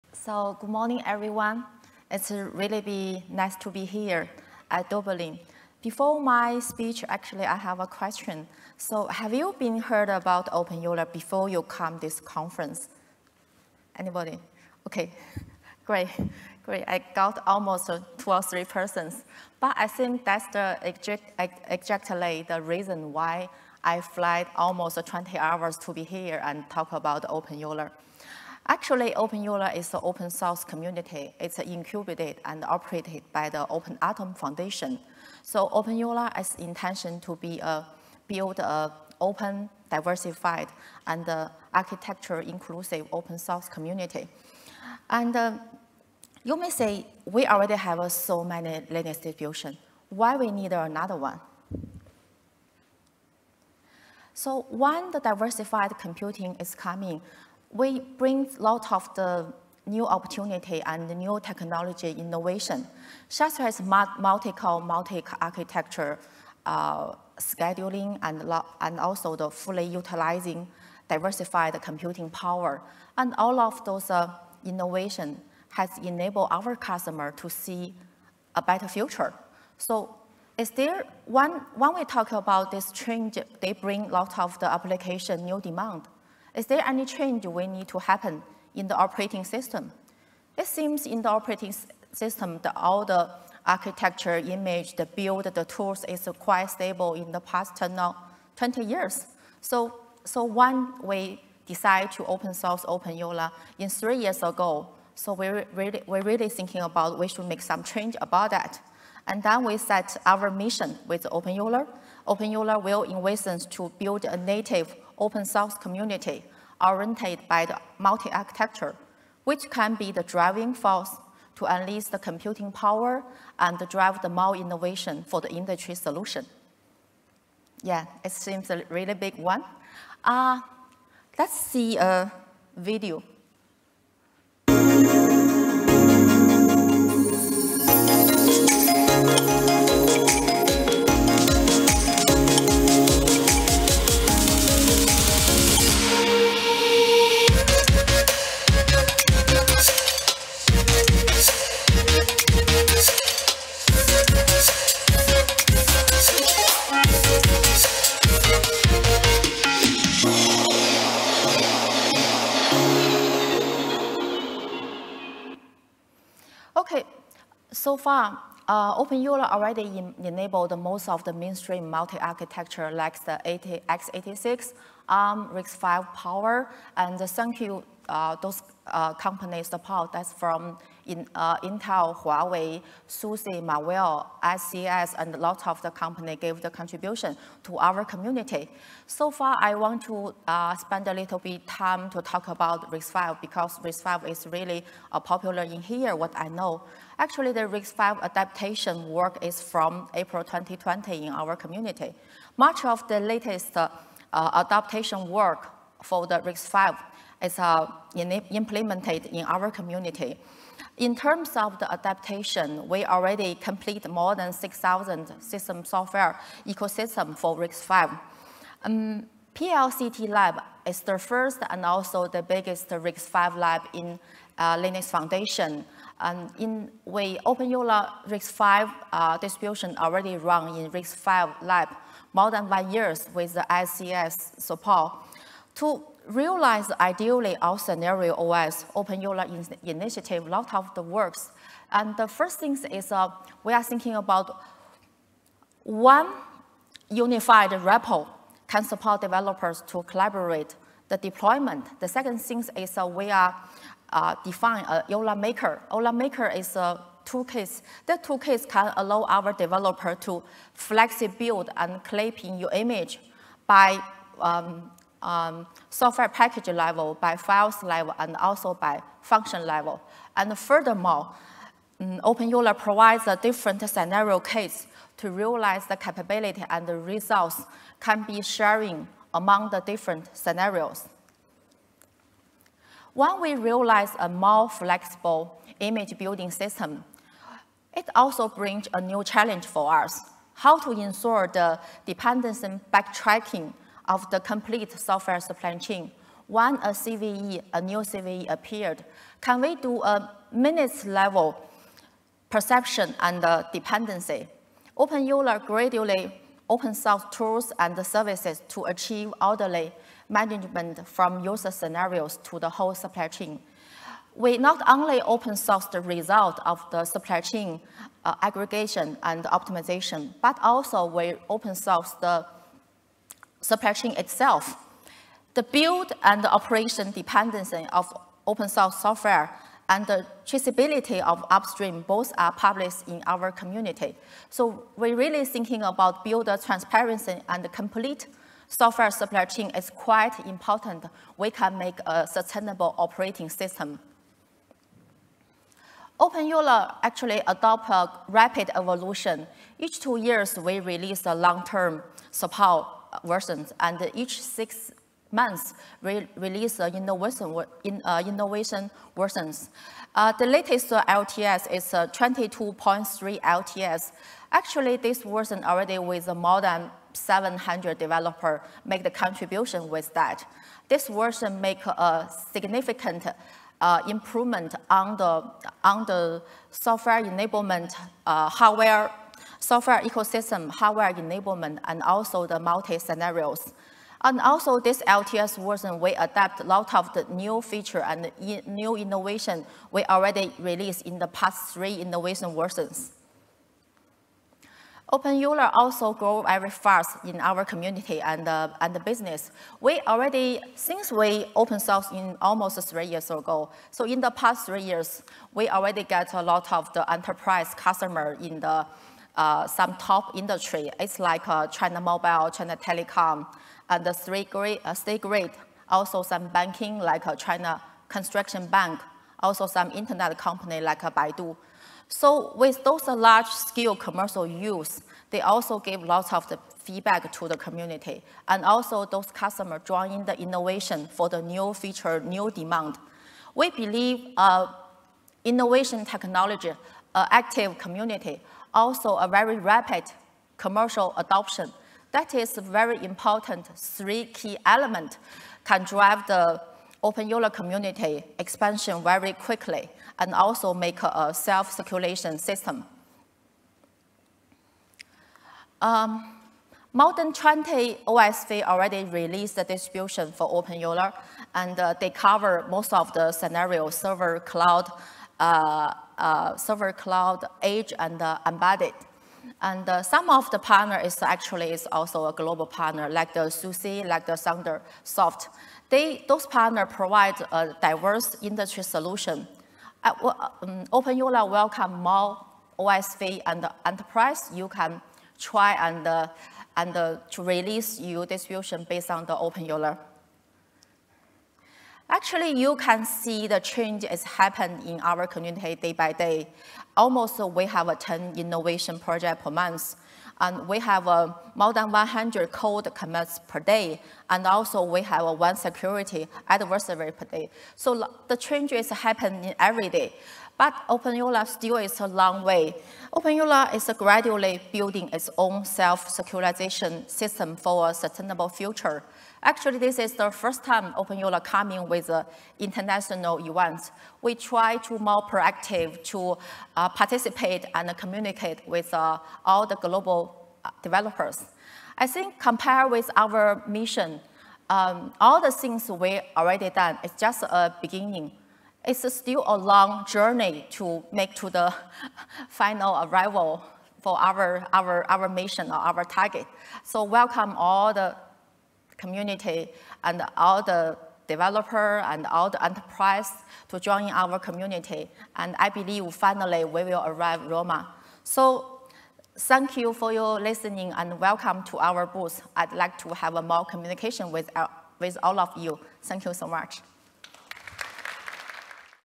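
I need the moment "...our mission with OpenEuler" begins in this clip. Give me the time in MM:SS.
01:50.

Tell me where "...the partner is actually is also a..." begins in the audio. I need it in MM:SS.
07:50.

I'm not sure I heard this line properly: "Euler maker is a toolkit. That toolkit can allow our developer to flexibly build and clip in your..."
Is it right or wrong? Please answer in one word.
right.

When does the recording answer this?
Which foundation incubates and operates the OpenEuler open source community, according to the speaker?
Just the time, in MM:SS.
00:33.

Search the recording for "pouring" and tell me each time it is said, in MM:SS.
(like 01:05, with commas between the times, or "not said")
not said.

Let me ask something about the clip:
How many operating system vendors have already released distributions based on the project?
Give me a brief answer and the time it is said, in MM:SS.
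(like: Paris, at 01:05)
More than 20, at 07:36.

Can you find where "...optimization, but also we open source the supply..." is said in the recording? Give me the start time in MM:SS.
05:19.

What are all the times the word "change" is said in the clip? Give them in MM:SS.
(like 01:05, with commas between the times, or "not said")
01:22, 01:27, 01:47, 08:13, 08:28.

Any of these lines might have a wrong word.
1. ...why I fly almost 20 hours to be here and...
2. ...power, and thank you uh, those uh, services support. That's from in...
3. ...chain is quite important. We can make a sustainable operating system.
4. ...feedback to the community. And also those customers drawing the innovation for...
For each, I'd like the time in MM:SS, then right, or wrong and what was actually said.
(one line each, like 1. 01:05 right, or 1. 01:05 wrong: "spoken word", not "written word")
1. 00:23 right
2. 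02:56 wrong: "companies", not "services"
3. 05:39 right
4. 07:06 right.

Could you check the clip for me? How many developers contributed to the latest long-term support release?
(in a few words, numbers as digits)
More than 700.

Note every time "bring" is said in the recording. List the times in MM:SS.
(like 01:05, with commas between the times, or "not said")
00:58, 01:23, 04:48.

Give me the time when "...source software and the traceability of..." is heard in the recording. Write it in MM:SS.
05:28.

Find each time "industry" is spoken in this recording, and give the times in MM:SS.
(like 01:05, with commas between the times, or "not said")
02:05, 06:50, 07:58.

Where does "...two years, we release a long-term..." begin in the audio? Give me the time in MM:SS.
05:49.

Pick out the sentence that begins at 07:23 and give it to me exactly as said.
Three key elements can drive the Open Euler community expansion very quickly and also make a self-circulation system.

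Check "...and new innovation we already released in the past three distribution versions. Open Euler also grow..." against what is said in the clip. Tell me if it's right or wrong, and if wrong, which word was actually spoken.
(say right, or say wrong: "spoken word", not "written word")
wrong: "innovation", not "distribution".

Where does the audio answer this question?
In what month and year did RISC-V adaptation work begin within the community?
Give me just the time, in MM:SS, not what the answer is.
03:20.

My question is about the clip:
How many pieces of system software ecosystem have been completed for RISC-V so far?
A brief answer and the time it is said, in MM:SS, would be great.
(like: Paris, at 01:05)
More than 6,000, at 03:34.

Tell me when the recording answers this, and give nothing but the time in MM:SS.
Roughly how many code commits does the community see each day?
08:21.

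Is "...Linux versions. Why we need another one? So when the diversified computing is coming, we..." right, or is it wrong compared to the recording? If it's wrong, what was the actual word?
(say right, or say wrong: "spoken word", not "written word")
wrong: "distributions", not "versions".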